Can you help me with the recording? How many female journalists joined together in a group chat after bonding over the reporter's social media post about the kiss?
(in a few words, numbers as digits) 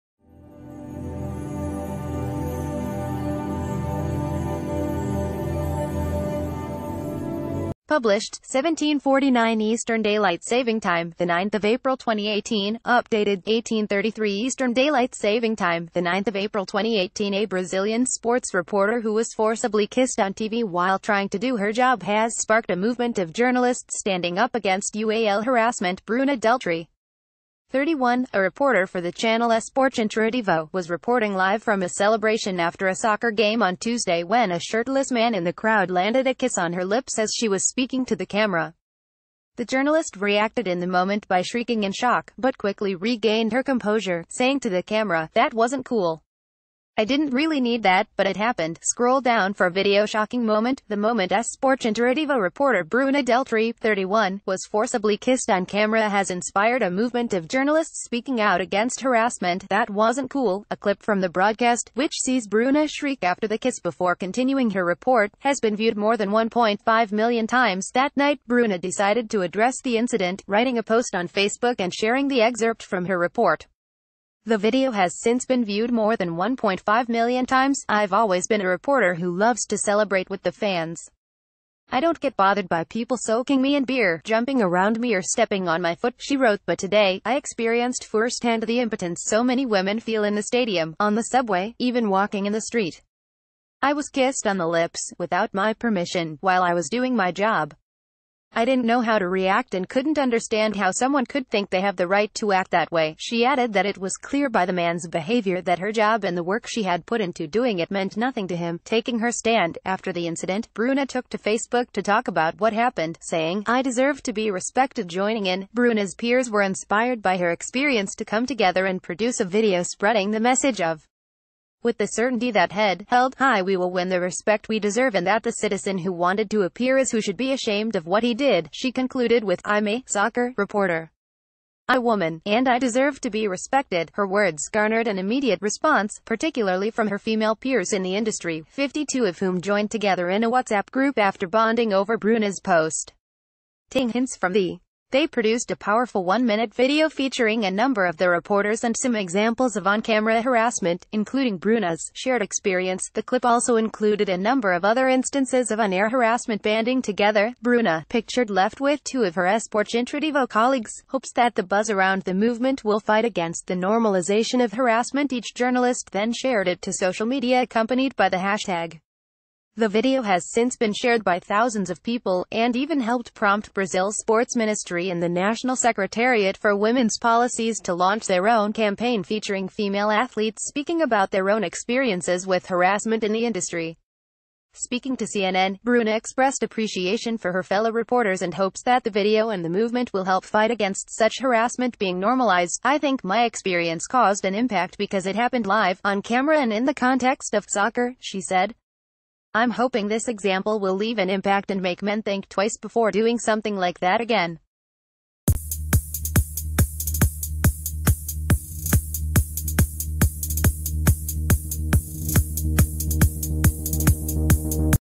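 52.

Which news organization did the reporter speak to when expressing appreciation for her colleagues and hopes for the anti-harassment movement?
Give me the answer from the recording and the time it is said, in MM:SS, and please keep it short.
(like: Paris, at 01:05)
CNN, at 03:05.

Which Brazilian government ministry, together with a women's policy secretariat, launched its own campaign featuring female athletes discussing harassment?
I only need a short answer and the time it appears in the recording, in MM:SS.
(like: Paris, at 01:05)
Sports Ministry, at 02:54.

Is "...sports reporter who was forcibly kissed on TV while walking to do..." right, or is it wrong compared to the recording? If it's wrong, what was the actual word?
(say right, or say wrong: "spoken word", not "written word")
wrong: "trying", not "walking".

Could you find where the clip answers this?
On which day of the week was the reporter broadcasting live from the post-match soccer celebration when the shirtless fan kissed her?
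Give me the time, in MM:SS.
00:33.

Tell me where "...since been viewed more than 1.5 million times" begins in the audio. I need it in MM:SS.
01:15.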